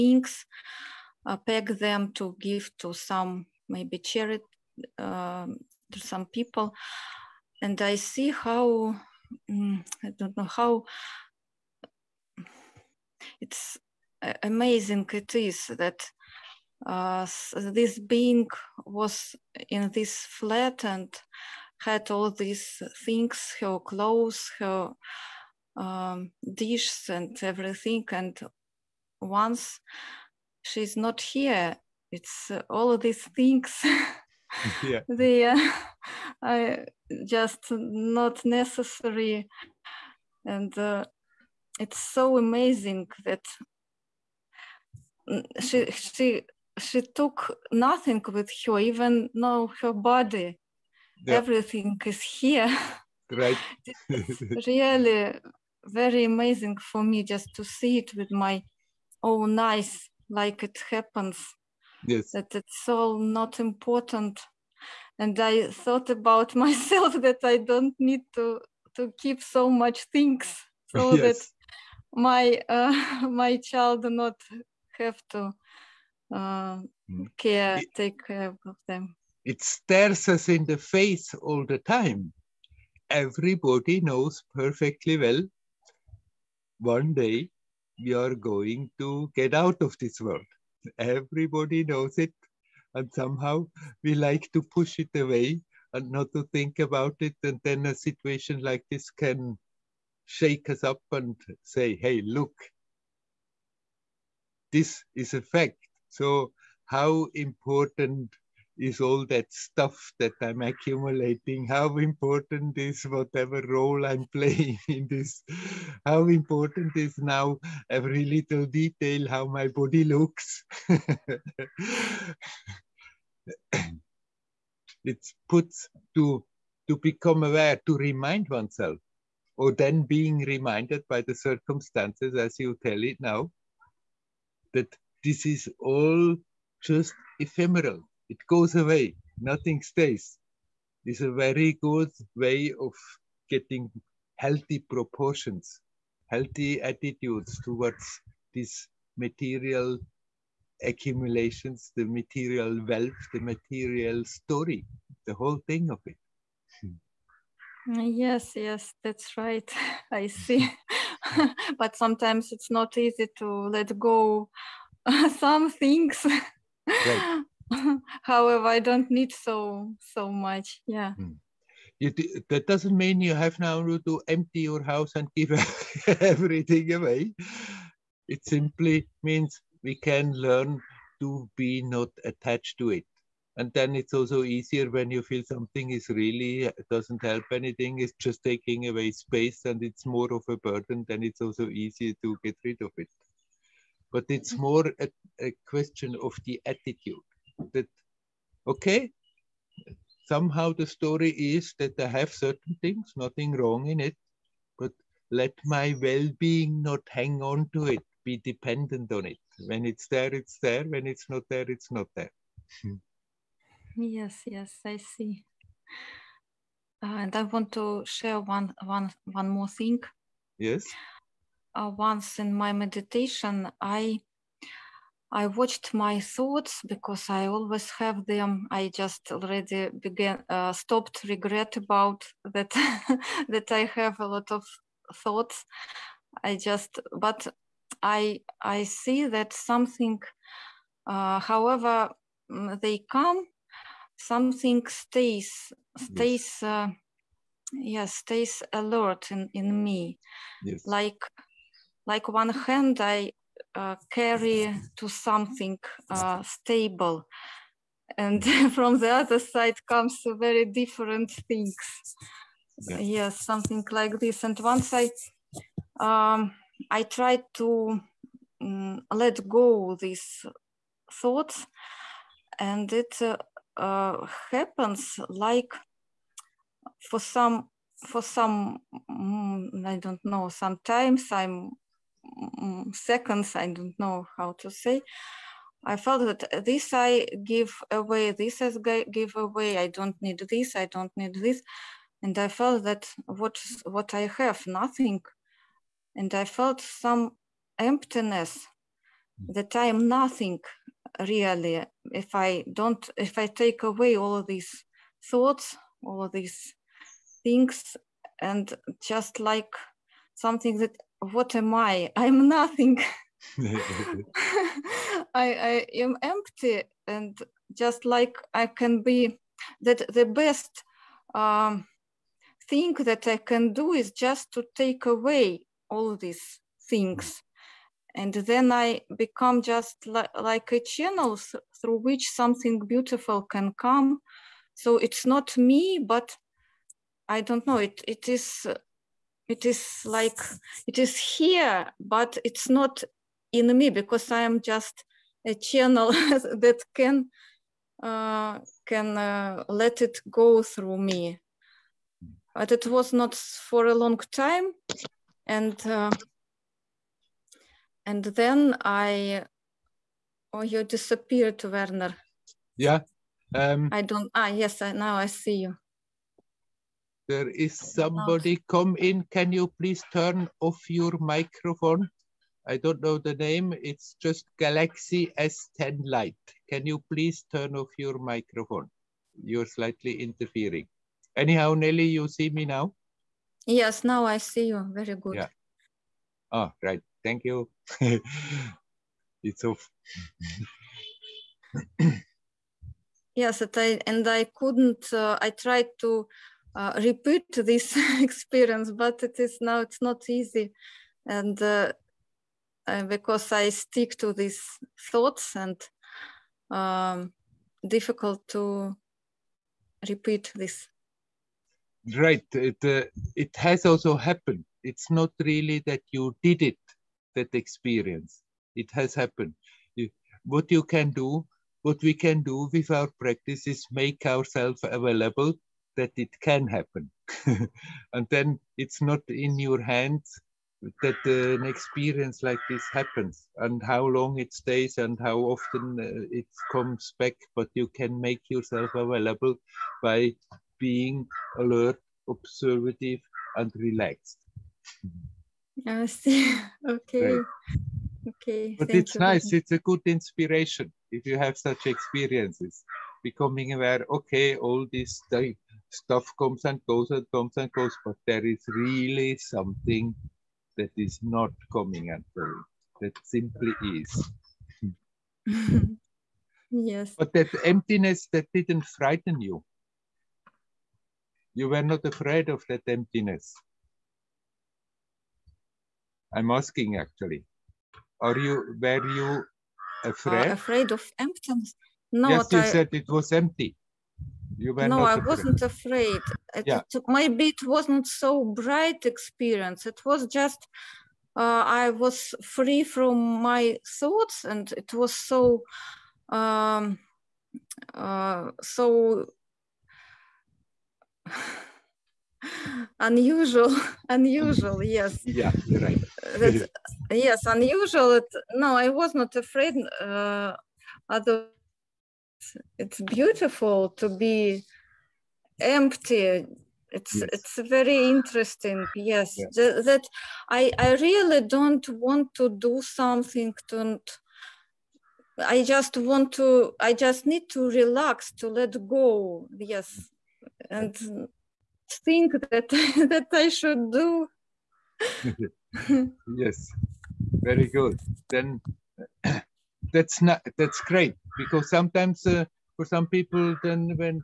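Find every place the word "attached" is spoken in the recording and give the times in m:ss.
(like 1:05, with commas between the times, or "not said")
3:02.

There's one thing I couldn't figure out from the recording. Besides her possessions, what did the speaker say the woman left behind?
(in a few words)
Her body.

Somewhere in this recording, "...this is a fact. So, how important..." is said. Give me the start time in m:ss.
1:44.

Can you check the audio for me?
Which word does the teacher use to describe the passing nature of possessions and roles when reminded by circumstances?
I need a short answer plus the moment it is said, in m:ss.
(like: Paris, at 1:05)
Ephemeral, at 2:17.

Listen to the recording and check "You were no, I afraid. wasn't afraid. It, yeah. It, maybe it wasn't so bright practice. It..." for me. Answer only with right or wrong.
wrong.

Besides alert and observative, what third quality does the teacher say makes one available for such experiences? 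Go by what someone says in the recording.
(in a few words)
Relaxed.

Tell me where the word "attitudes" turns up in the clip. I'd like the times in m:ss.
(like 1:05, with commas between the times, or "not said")
2:26, 3:16.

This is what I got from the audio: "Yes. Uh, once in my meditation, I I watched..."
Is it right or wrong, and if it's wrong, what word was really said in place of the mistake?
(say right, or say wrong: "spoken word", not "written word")
right.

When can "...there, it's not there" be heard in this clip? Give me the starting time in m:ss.
3:31.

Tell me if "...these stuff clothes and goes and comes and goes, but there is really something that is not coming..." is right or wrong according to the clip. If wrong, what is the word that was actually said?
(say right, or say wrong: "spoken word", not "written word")
wrong: "comes", not "clothes".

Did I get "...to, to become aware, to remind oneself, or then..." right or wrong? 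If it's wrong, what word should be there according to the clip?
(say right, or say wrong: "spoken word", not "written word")
right.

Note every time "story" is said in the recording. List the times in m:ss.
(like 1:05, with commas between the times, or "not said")
2:34, 3:20.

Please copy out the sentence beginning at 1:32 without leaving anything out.
And somehow we like to push it away and not to think about it.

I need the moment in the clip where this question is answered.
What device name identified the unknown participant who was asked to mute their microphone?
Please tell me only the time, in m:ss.
6:14.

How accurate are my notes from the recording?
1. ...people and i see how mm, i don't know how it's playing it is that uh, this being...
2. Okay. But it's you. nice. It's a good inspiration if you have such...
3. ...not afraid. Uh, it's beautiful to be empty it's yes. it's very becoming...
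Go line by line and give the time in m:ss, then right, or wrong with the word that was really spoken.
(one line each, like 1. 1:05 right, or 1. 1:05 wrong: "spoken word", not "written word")
1. 0:06 wrong: "amazing", not "playing"
2. 7:28 right
3. 8:29 wrong: "interesting", not "becoming".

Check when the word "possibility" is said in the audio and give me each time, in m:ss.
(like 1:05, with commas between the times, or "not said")
not said.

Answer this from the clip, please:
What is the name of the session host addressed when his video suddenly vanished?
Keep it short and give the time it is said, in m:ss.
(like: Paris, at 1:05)
Werner, at 6:01.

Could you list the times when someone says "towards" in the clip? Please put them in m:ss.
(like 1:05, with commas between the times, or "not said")
2:27.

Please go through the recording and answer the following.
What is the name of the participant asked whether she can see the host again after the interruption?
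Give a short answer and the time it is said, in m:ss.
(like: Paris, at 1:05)
Nelly, at 6:21.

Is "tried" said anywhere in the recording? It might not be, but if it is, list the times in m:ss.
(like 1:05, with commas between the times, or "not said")
4:27, 6:35.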